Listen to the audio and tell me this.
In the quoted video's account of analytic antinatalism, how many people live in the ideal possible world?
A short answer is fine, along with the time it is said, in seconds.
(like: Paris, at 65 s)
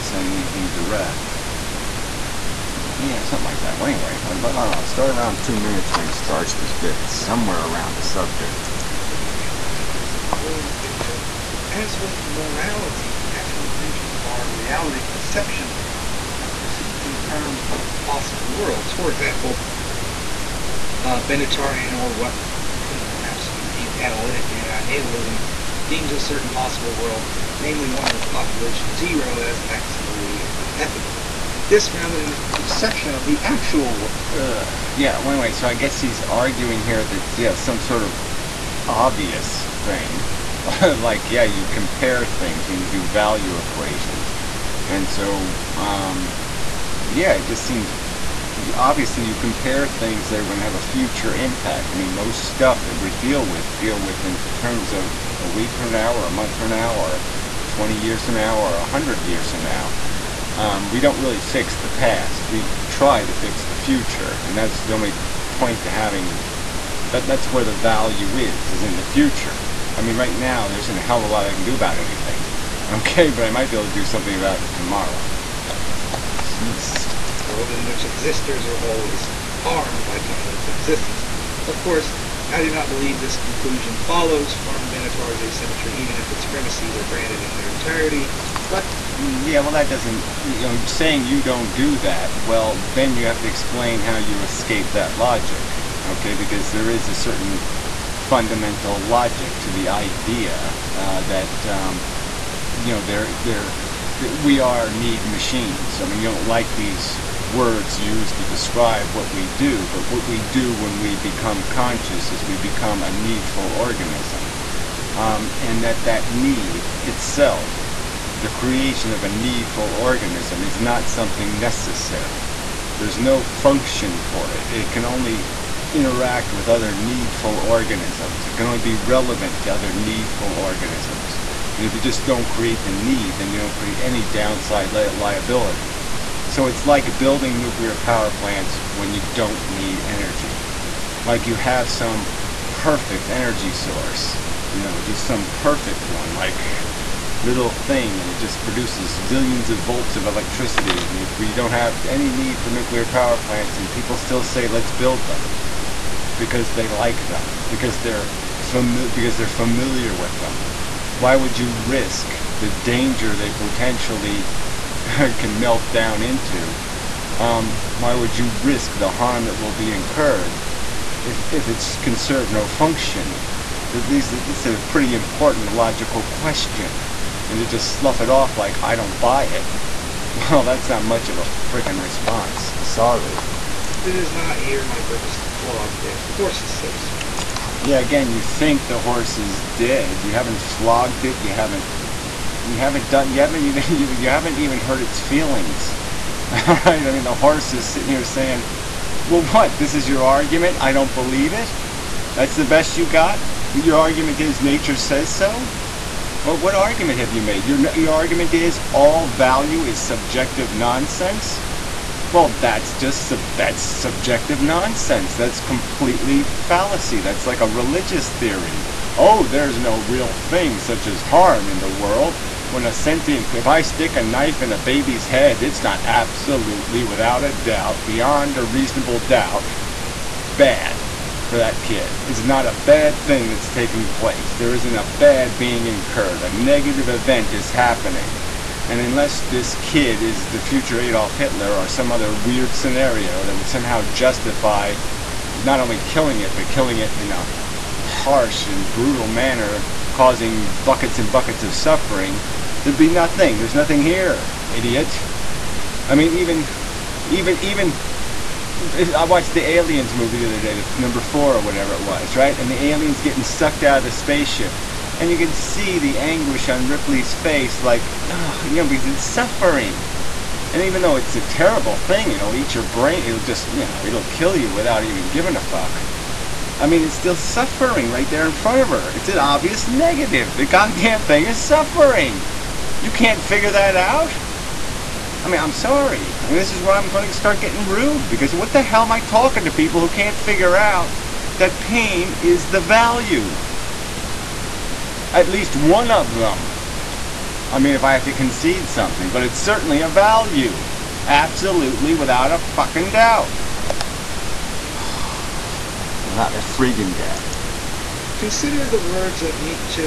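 0, at 28 s.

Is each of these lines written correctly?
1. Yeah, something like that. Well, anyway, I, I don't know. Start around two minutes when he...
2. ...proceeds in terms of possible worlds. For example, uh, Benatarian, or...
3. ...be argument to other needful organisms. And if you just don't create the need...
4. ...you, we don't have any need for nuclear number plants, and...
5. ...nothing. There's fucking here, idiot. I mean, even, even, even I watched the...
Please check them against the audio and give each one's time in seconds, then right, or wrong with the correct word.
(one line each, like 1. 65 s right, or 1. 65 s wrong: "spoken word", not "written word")
1. 2 s right
2. 16 s right
3. 128 s wrong: "relevant", not "argument"
4. 151 s wrong: "power", not "number"
5. 253 s wrong: "nothing", not "fucking".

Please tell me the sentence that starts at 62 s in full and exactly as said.
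We try to fix the future, and that's the only point to having that.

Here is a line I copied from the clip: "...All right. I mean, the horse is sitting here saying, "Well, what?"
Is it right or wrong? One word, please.
right.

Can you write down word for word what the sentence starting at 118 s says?
The creation of a needful organism is not something necessary.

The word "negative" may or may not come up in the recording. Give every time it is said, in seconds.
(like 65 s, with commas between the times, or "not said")
236 s, 279 s.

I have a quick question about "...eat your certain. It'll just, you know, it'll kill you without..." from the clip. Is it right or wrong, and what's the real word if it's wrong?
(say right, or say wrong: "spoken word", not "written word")
wrong: "brain", not "certain".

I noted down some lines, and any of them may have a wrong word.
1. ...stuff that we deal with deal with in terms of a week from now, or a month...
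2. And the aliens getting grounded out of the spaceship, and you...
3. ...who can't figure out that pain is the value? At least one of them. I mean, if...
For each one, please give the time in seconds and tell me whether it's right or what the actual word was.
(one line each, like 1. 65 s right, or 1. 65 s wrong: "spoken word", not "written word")
1. 52 s right
2. 262 s wrong: "sucked", not "grounded"
3. 290 s right.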